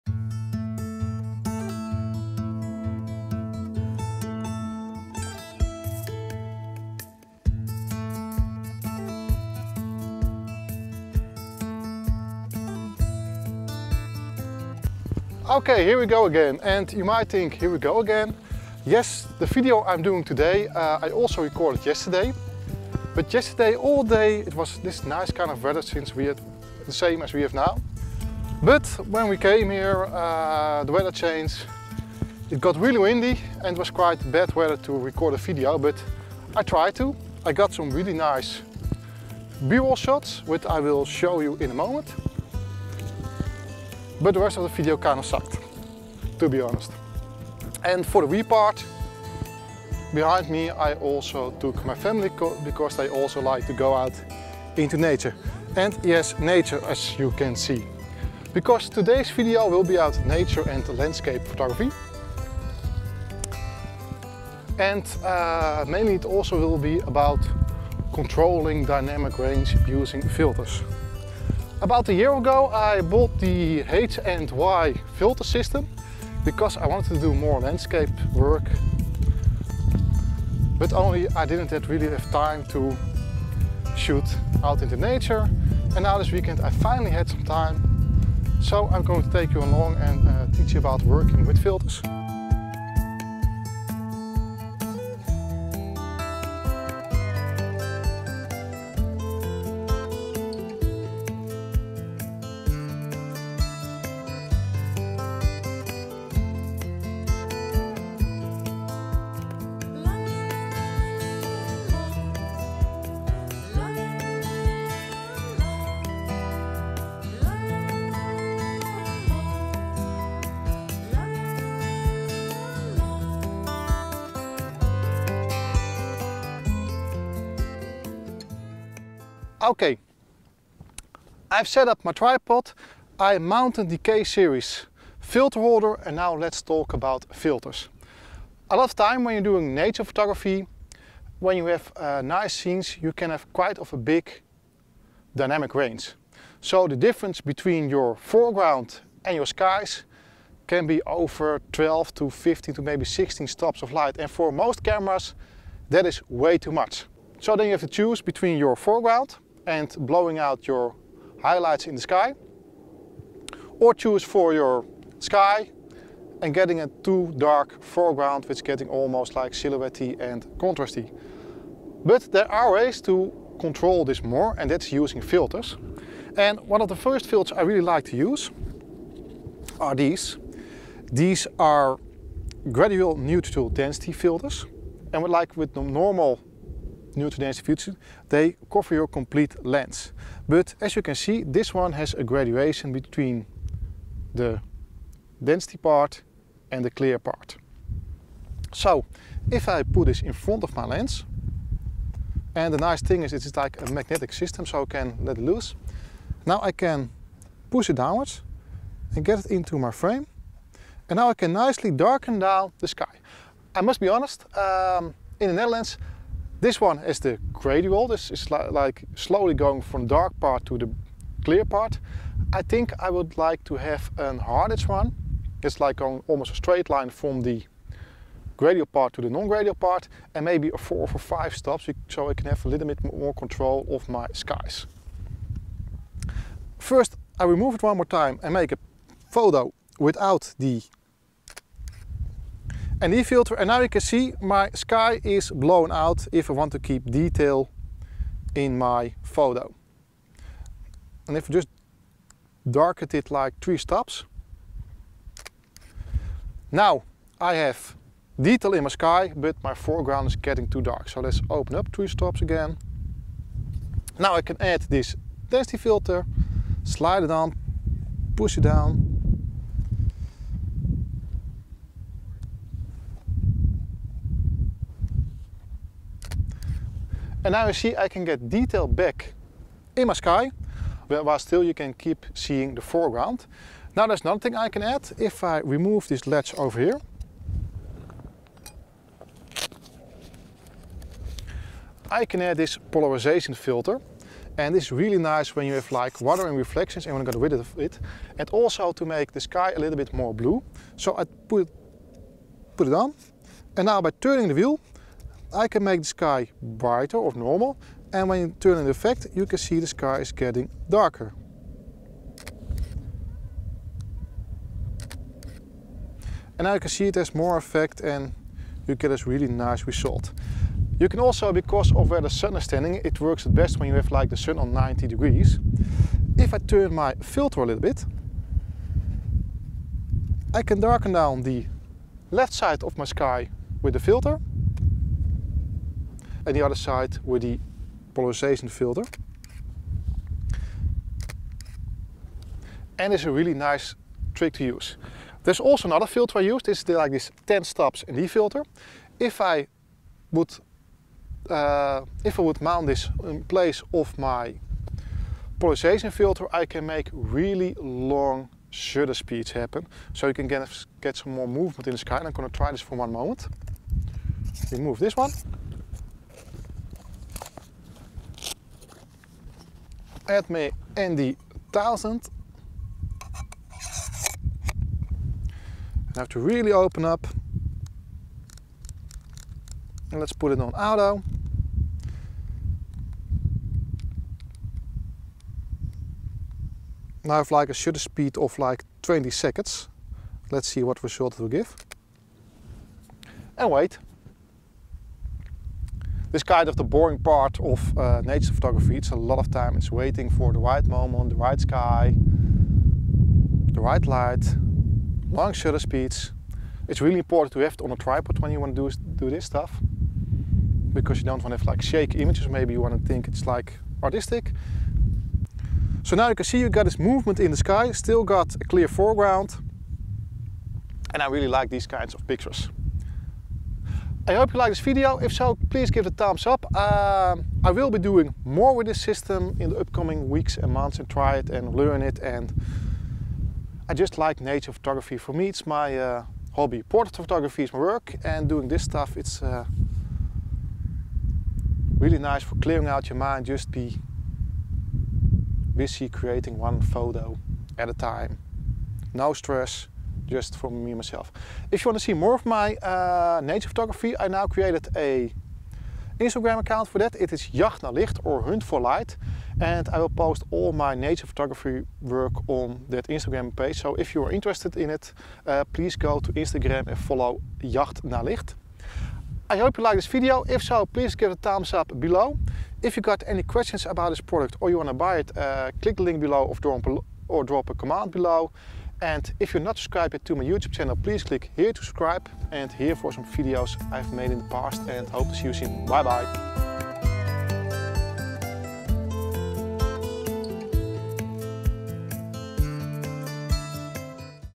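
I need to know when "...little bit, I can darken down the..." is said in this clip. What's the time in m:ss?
5:27.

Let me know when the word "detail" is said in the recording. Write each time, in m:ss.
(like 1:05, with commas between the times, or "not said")
4:07, 4:18, 4:38.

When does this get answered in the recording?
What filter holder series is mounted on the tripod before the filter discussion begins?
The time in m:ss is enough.
2:13.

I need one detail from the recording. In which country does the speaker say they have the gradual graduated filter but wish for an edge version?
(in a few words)
Netherlands.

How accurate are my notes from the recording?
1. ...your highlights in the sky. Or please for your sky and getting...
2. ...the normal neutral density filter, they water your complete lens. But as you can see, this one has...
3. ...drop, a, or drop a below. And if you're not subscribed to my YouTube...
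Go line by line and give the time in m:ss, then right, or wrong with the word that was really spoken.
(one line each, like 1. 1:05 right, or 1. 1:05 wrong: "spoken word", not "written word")
1. 2:40 wrong: "choose", not "please"
2. 3:05 wrong: "cover", not "water"
3. 7:56 right.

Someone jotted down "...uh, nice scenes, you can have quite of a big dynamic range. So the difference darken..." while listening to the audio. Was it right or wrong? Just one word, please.
wrong.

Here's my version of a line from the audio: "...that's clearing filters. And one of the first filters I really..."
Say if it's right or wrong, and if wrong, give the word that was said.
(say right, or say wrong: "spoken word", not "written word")
wrong: "using", not "clearing".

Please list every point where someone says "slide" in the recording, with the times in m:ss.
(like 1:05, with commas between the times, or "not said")
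4:26.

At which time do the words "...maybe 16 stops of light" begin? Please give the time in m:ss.
2:32.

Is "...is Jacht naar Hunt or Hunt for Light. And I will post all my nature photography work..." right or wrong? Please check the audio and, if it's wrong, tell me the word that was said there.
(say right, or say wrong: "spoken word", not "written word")
wrong: "Licht", not "Hunt".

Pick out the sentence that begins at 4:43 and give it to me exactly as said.
Now there's another thing I can add.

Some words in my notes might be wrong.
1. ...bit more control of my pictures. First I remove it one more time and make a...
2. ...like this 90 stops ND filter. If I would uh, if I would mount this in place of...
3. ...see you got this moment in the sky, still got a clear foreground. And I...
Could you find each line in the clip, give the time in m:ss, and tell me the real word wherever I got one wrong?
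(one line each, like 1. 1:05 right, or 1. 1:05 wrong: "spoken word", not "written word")
1. 3:52 wrong: "skies", not "pictures"
2. 5:46 wrong: "10", not "90"
3. 6:56 wrong: "movement", not "moment".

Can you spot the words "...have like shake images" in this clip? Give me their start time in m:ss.
6:51.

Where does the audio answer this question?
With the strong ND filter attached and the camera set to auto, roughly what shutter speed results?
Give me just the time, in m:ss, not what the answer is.
6:29.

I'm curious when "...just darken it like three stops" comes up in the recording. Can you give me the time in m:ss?
4:11.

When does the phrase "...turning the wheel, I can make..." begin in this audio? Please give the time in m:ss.
5:04.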